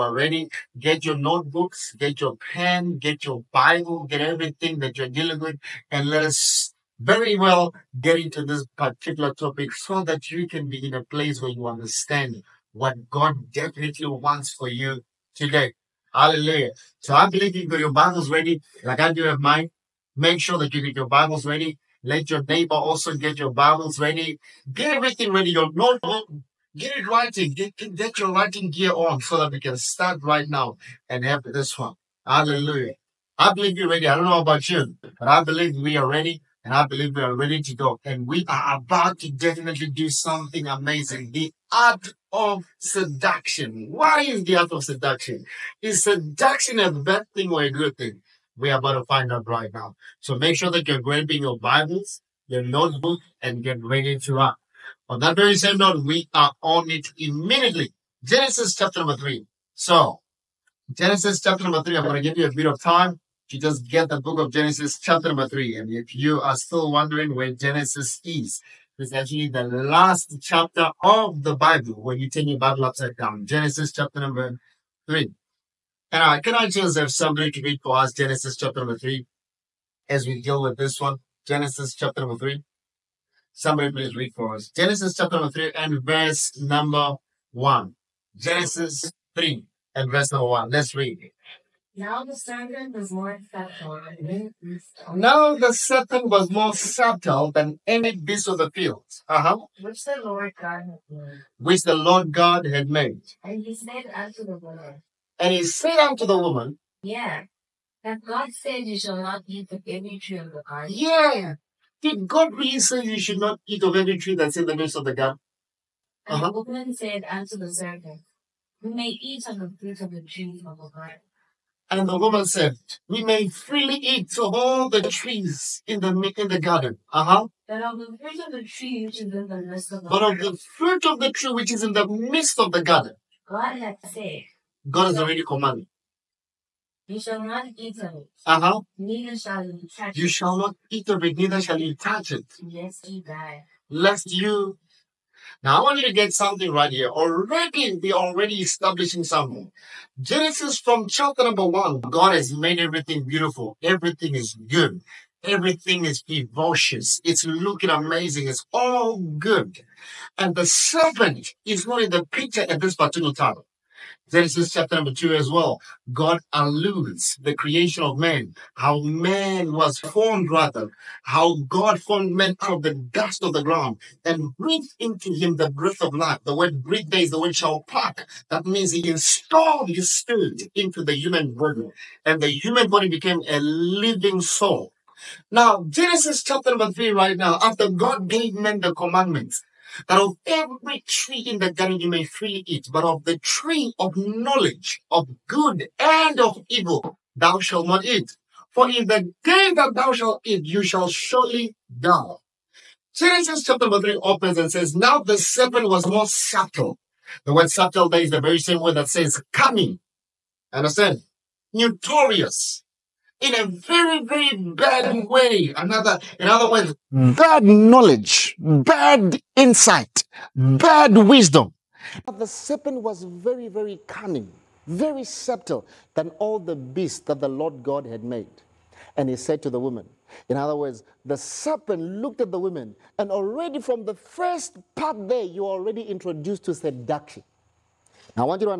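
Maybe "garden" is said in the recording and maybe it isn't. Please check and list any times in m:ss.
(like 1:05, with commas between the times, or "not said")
1:50, 1:55, 2:00, 2:06, 2:12, 3:11.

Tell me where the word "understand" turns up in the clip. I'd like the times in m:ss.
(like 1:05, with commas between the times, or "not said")
0:11, 3:30.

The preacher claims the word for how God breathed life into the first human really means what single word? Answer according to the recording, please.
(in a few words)
pluck.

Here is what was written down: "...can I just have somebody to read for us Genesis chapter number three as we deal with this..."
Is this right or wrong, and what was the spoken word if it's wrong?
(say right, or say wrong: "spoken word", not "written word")
right.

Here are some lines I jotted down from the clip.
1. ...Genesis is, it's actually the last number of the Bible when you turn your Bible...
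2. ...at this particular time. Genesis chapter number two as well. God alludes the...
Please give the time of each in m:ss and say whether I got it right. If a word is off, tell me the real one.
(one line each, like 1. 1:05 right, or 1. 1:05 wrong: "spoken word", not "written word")
1. 1:07 wrong: "chapter", not "number"
2. 2:42 right.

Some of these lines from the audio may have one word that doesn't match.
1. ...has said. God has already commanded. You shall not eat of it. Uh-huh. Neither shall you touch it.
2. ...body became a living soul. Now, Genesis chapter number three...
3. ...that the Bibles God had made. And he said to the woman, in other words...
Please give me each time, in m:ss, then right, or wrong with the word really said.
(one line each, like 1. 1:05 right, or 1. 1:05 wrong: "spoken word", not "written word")
1. 2:13 right
2. 3:02 right
3. 3:47 wrong: "Lord", not "Bibles".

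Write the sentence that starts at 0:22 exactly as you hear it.
Let your neighbor also get your Bibles ready.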